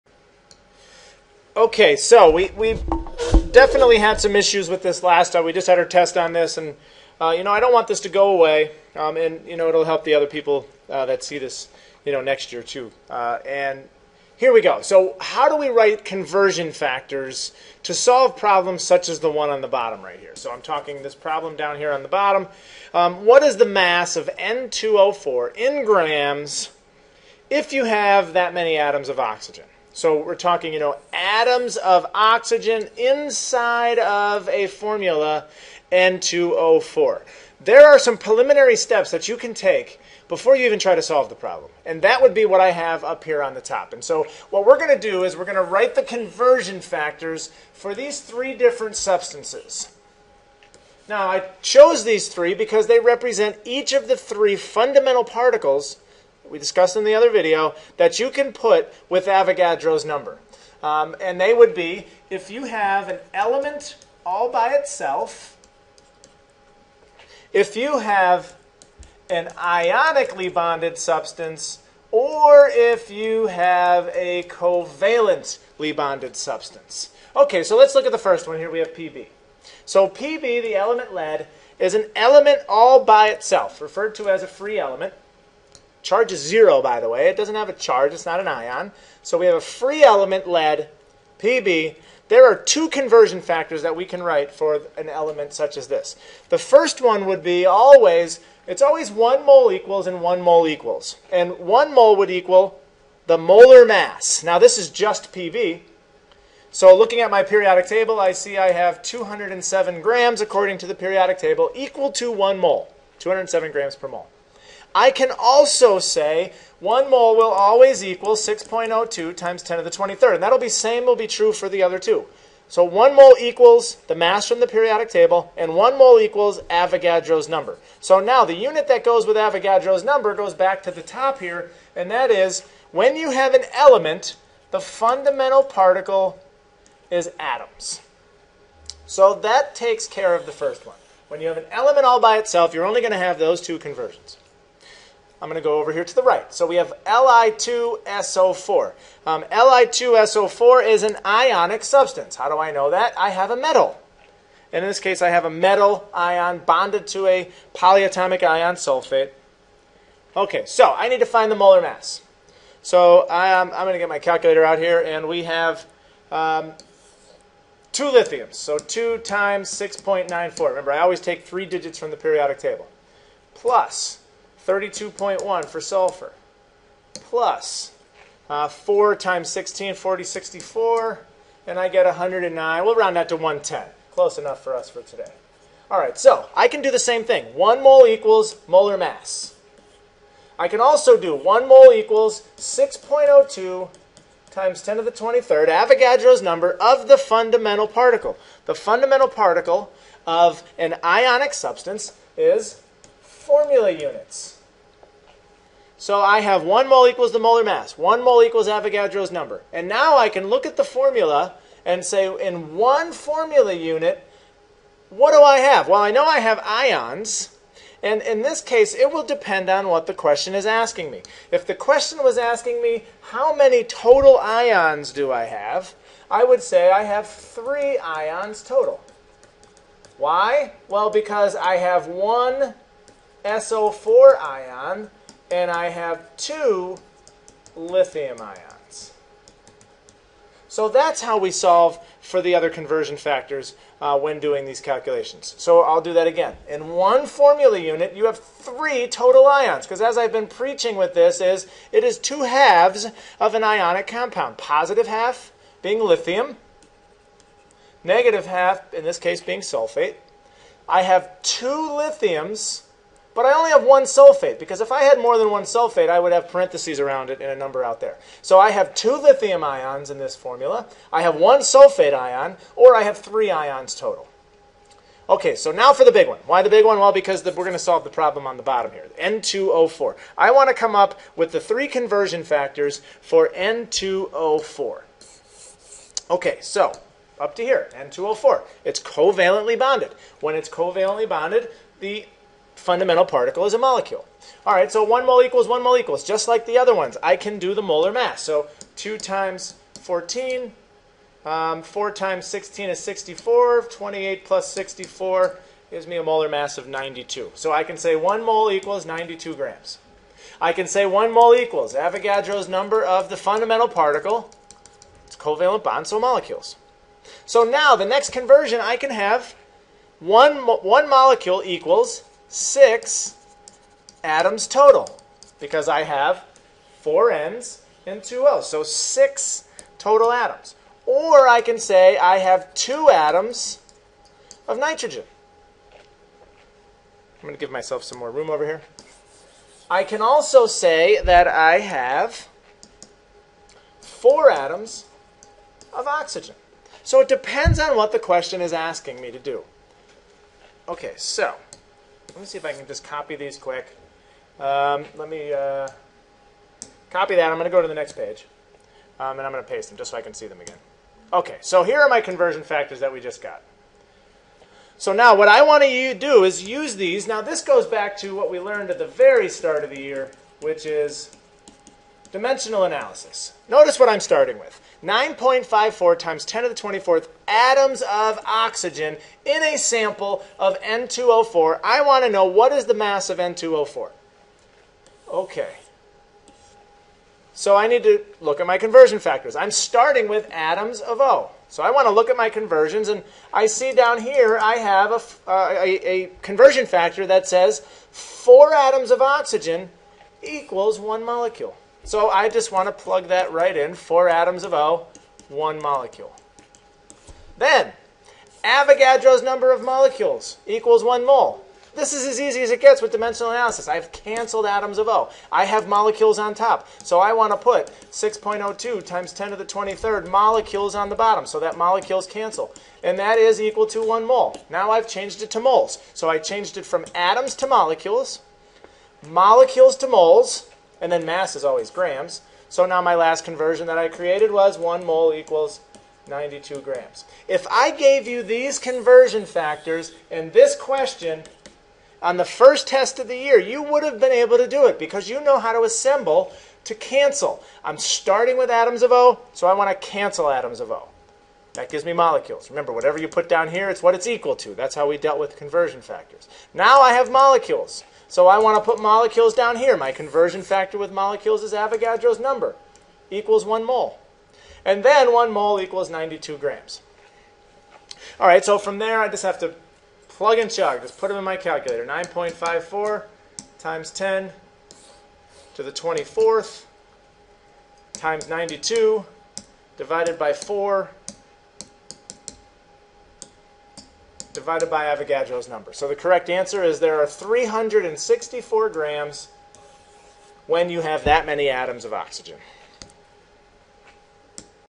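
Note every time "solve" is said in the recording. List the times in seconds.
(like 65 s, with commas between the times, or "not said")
17 s, 41 s, 241 s, 277 s.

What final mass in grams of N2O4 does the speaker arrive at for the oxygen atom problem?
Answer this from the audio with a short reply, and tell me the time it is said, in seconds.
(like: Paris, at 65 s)
364, at 487 s.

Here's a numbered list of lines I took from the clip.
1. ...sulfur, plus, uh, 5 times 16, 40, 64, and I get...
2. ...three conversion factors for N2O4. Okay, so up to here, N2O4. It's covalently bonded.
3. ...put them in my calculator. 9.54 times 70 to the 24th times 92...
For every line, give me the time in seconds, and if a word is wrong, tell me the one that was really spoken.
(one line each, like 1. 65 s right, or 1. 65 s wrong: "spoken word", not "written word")
1. 175 s wrong: "4", not "5"
2. 281 s right
3. 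471 s wrong: "10", not "70".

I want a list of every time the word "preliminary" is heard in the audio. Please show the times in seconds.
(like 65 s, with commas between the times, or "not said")
38 s.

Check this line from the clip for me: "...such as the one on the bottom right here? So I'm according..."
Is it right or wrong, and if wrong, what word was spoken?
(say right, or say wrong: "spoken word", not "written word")
wrong: "talking", not "according".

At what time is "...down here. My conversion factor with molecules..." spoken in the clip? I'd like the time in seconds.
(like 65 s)
459 s.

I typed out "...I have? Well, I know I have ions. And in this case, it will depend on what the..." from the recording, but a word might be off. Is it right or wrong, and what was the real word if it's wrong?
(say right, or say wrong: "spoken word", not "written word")
right.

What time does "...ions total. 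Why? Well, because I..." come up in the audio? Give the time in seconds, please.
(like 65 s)
227 s.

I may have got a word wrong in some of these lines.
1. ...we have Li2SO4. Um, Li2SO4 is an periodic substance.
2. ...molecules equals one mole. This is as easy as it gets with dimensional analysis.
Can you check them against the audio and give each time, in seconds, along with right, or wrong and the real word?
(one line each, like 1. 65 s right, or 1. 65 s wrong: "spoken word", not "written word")
1. 146 s wrong: "ionic", not "periodic"
2. 409 s right.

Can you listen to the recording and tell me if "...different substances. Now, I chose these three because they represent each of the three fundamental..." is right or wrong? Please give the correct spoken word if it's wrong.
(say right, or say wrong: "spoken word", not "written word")
right.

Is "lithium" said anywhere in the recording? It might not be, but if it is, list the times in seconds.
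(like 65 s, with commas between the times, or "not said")
168 s, 237 s, 256 s, 261 s, 269 s.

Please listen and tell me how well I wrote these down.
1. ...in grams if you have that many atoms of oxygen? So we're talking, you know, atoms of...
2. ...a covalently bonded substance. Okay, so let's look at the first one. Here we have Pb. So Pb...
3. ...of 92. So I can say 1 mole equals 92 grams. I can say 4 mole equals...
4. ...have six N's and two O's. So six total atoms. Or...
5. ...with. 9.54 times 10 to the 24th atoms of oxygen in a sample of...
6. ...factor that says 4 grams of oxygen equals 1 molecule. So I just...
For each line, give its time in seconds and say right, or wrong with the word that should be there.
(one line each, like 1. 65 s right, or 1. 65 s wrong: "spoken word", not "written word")
1. 25 s right
2. 74 s right
3. 306 s wrong: "1", not "4"
4. 326 s wrong: "four", not "six"
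5. 374 s right
6. 396 s wrong: "atoms", not "grams".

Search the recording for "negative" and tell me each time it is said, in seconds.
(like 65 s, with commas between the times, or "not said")
258 s.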